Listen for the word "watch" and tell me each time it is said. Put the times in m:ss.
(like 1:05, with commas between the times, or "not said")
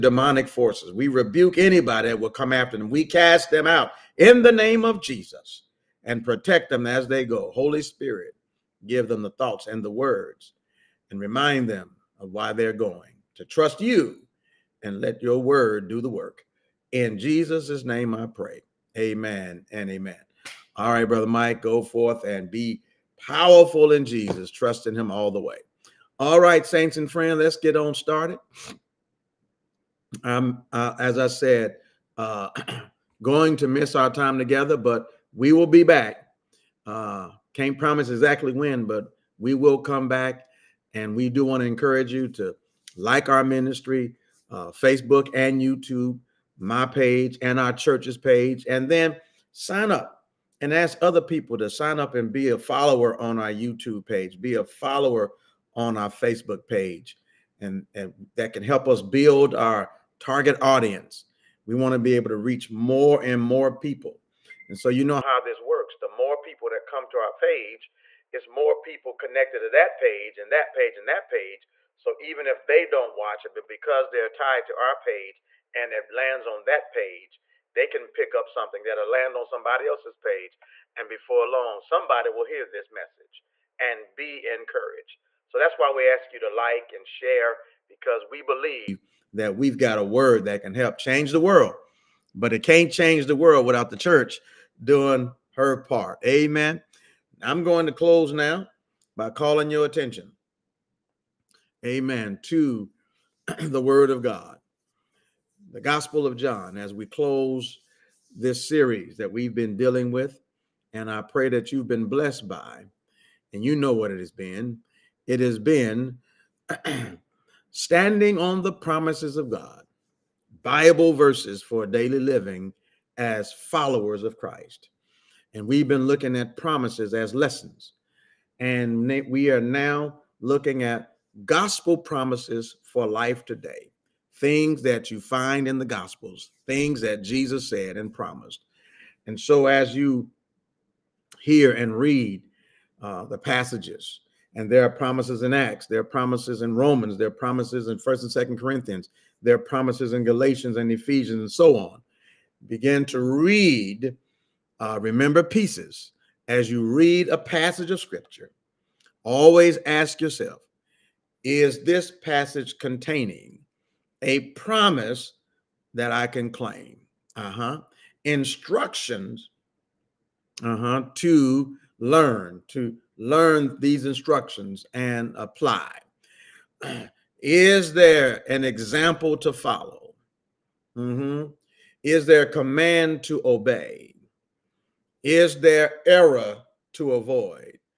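1:13.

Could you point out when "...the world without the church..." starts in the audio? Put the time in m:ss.
1:33.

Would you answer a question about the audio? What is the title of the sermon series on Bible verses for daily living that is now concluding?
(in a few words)
Standing on the promises of God.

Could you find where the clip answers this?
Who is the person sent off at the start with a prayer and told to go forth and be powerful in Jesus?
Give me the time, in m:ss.
0:21.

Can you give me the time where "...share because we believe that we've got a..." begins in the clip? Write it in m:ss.
1:27.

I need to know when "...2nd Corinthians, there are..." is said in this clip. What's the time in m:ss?
2:28.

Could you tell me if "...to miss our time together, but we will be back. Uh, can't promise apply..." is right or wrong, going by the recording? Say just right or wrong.
wrong.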